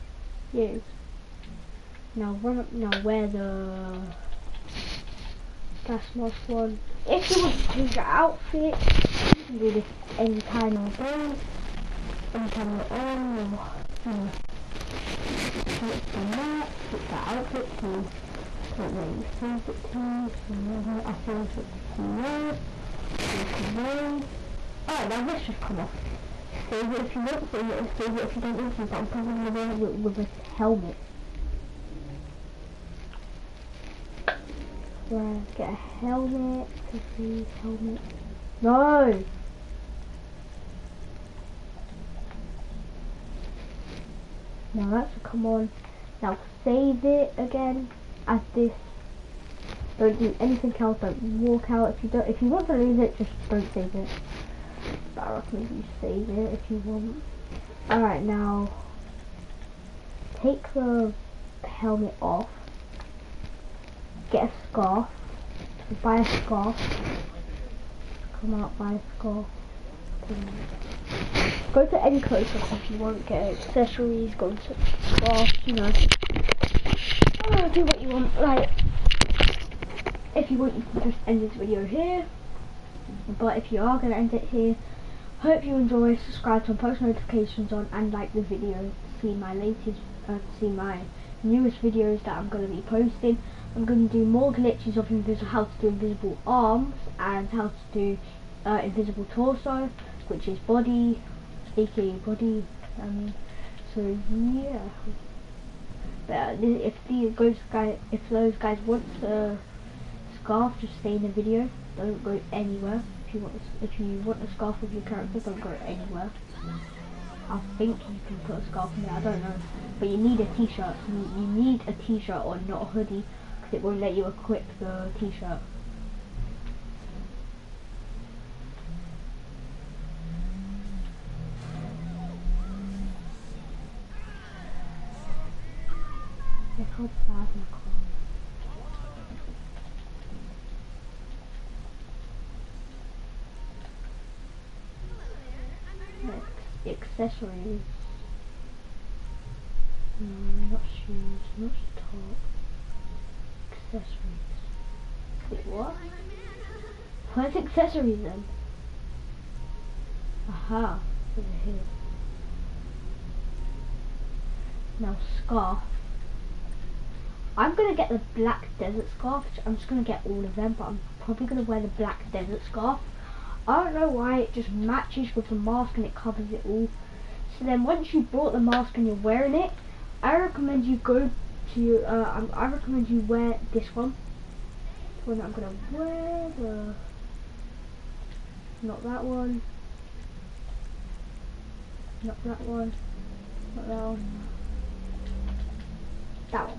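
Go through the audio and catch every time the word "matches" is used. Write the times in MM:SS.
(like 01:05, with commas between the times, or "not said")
02:54.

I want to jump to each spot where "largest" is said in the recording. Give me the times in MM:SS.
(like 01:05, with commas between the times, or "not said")
not said.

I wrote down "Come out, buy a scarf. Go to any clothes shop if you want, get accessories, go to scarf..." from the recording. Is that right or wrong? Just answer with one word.
right.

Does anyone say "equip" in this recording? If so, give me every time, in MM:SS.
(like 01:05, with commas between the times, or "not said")
02:04.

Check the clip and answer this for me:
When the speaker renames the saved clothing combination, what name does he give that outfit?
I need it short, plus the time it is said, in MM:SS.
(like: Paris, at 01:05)
CEO, at 00:22.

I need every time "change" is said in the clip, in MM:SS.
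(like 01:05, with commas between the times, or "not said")
00:07, 00:21.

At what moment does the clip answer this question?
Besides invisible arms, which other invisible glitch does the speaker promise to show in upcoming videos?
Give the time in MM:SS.
01:38.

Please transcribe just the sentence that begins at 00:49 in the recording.
Don't do anything else, don't walk out.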